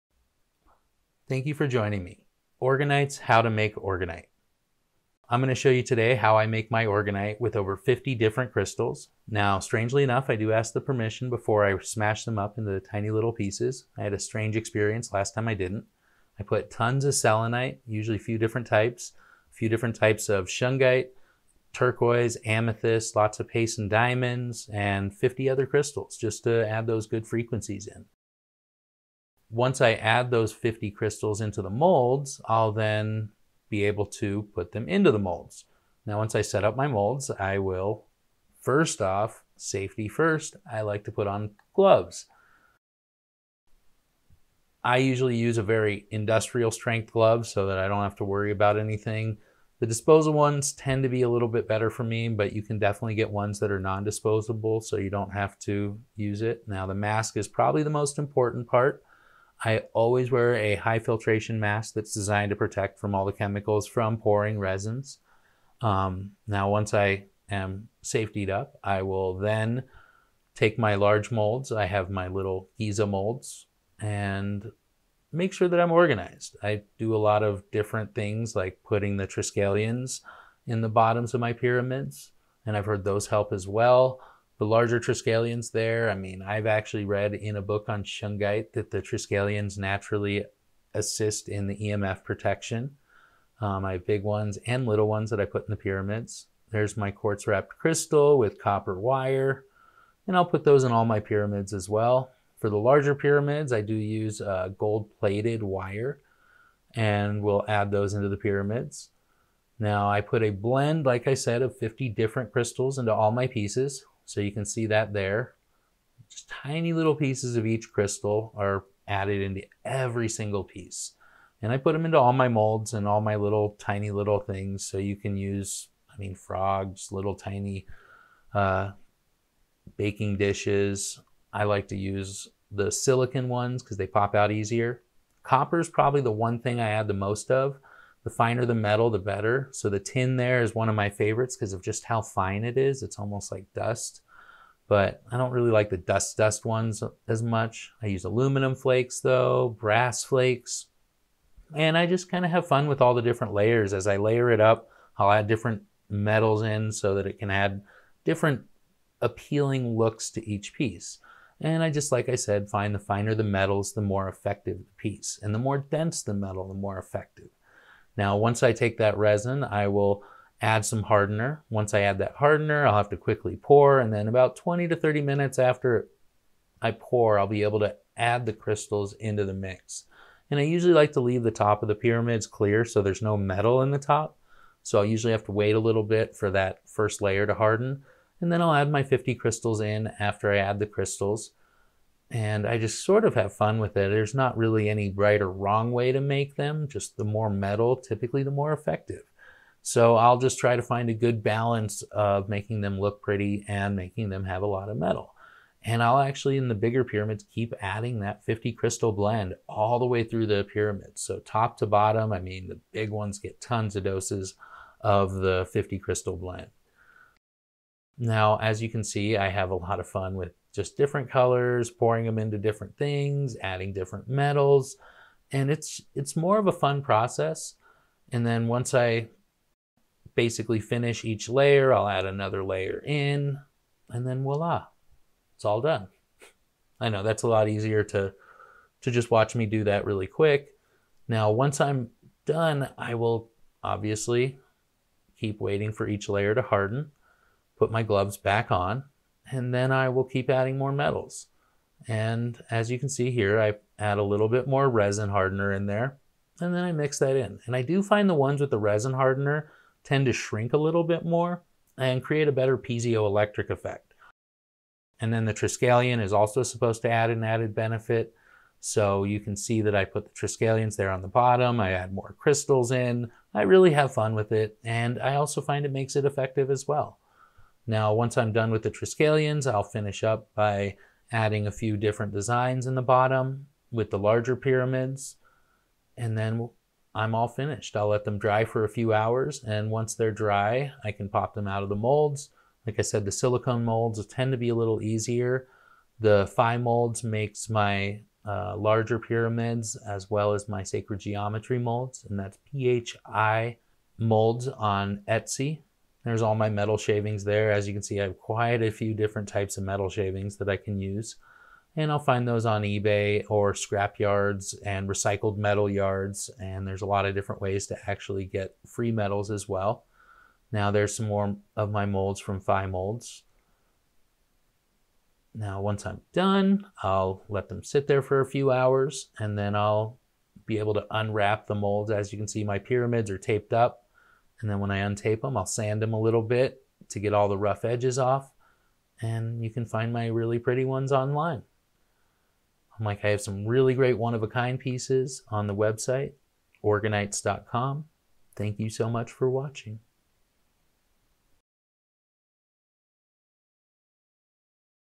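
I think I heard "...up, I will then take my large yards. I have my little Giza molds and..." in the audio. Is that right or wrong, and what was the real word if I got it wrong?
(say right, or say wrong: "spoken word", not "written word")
wrong: "molds", not "yards".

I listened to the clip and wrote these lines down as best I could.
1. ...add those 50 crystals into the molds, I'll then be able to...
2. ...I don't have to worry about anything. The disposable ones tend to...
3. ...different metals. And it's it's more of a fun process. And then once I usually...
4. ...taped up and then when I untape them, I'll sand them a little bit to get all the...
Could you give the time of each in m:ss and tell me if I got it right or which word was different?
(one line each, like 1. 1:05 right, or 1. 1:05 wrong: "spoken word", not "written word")
1. 0:29 right
2. 0:47 right
3. 3:43 wrong: "basically", not "usually"
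4. 5:33 right.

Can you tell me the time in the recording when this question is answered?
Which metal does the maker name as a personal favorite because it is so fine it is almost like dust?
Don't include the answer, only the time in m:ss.
2:19.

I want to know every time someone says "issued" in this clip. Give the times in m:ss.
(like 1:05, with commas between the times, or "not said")
not said.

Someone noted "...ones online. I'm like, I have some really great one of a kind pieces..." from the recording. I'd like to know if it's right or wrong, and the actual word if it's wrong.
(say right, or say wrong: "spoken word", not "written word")
right.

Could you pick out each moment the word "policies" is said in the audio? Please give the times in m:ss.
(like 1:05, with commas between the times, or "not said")
not said.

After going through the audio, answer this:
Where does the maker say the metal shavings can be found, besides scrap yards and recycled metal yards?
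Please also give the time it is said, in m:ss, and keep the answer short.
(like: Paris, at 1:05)
eBay, at 5:12.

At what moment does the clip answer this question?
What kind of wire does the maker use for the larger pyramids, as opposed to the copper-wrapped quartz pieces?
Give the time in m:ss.
1:44.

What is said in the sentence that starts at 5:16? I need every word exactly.
And there's a lot of different ways to actually get free metals as well.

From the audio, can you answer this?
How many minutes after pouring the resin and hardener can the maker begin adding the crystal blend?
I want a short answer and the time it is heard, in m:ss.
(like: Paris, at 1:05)
20 to 30, at 2:54.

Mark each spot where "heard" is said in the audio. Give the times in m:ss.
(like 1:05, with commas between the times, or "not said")
1:22.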